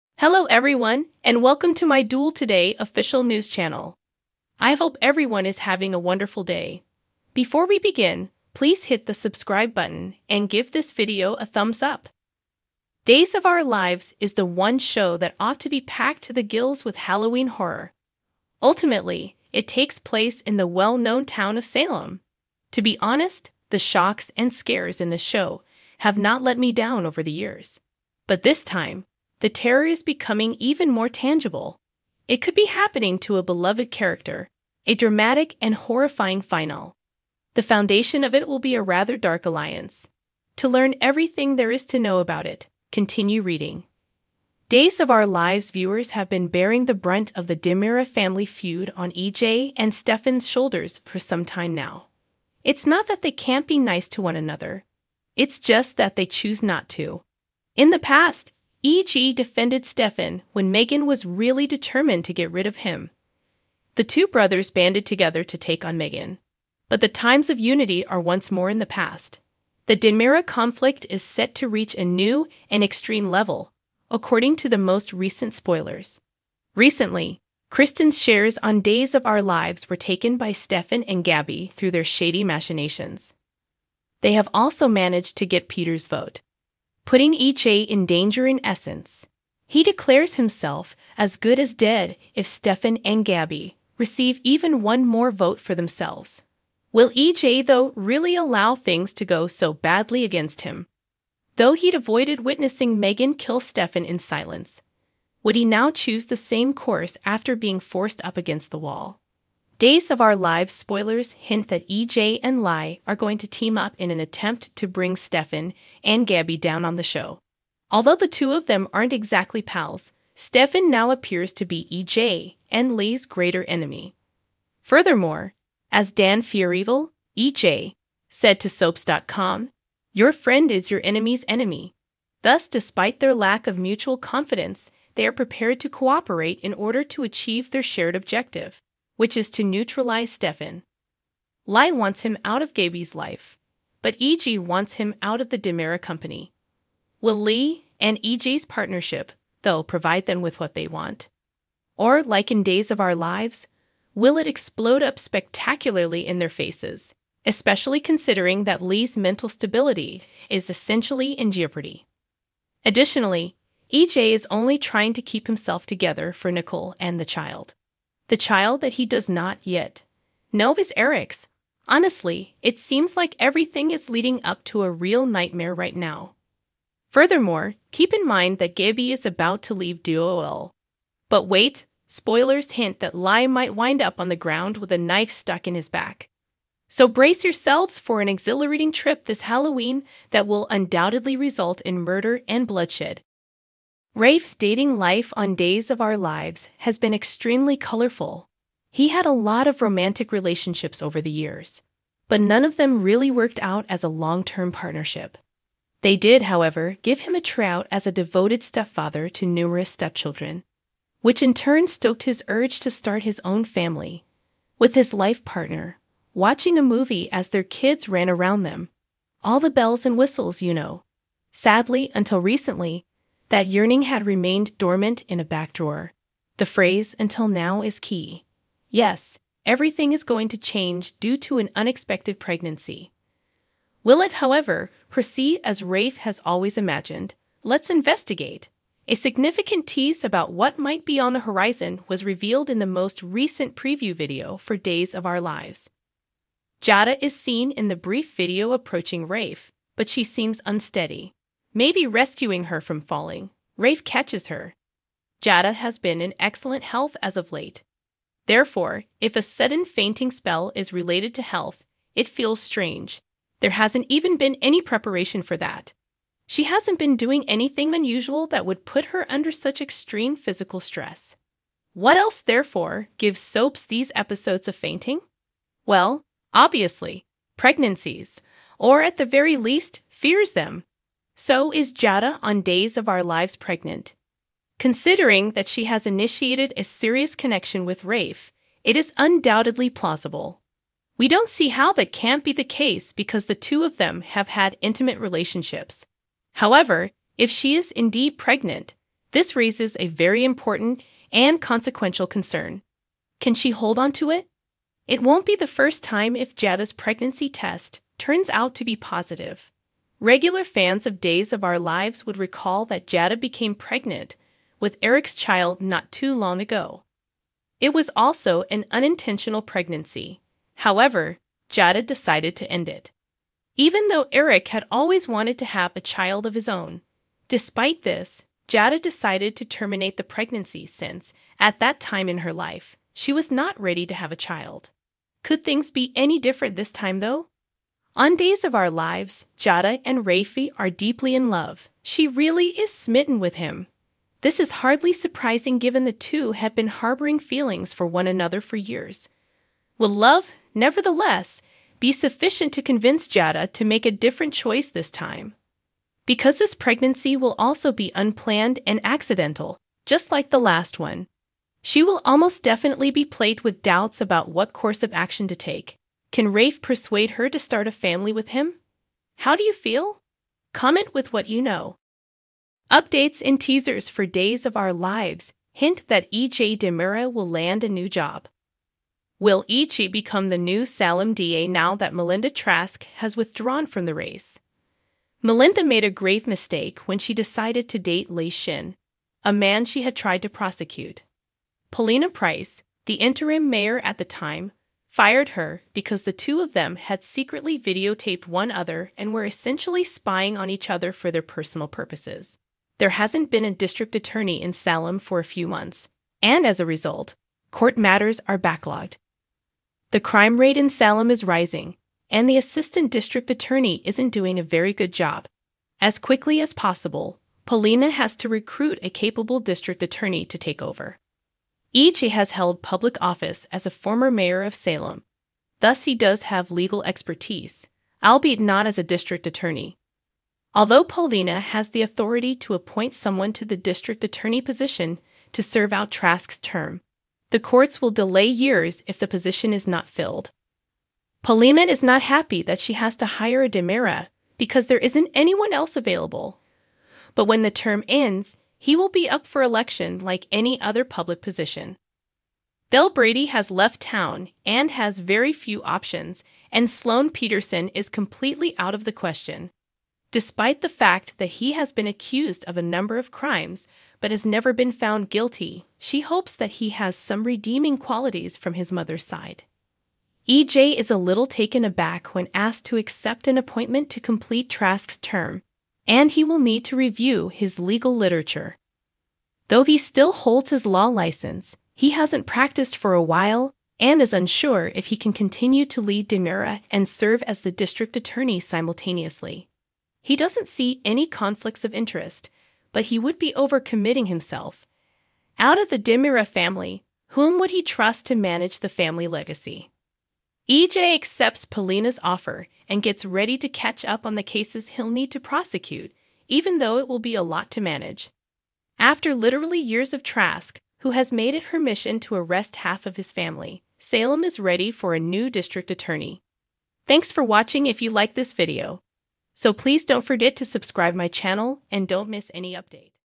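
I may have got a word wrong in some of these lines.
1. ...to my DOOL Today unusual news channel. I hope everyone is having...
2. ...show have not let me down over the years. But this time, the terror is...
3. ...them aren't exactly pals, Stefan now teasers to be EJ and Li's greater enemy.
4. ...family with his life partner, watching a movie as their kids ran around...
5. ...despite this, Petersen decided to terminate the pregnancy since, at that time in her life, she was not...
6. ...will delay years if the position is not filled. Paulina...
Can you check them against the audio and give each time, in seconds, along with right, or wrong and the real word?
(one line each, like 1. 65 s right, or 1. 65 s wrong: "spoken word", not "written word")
1. 1 s wrong: "official", not "unusual"
2. 25 s right
3. 118 s wrong: "appears", not "teasers"
4. 213 s right
5. 327 s wrong: "Jada", not "Petersen"
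6. 438 s right.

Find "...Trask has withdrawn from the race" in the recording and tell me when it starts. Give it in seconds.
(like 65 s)
382 s.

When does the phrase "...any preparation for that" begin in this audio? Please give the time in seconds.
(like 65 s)
264 s.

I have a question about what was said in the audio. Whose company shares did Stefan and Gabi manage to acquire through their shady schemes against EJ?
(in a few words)
Kristen.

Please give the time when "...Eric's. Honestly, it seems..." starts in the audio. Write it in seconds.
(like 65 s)
170 s.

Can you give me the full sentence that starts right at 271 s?
What else, therefore, gives soaps these episodes of fainting?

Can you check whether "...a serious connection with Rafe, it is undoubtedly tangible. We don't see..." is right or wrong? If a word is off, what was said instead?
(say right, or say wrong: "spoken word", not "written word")
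wrong: "plausible", not "tangible".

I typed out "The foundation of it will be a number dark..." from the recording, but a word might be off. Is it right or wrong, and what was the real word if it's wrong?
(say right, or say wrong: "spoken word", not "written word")
wrong: "rather", not "number".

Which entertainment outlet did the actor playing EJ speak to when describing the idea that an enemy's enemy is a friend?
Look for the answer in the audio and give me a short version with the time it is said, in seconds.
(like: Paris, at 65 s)
Soaps.com, at 128 s.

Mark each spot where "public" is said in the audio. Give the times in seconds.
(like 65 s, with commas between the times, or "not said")
422 s, 451 s.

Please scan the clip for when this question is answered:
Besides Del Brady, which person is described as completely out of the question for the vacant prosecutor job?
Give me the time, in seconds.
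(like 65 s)
456 s.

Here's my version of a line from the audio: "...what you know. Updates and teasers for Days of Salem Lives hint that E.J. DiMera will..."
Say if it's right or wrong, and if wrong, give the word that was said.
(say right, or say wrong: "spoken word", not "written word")
wrong: "Our", not "Salem".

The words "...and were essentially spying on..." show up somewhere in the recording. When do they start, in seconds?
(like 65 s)
399 s.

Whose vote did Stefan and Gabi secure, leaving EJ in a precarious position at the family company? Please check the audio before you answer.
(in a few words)
Peter.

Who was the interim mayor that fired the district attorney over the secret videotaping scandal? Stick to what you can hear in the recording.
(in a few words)
Paulina Price.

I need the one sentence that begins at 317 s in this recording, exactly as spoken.
It was also an unintentional pregnancy.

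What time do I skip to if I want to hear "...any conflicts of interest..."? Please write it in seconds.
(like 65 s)
491 s.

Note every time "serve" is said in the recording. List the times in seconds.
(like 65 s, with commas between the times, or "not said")
435 s, 487 s.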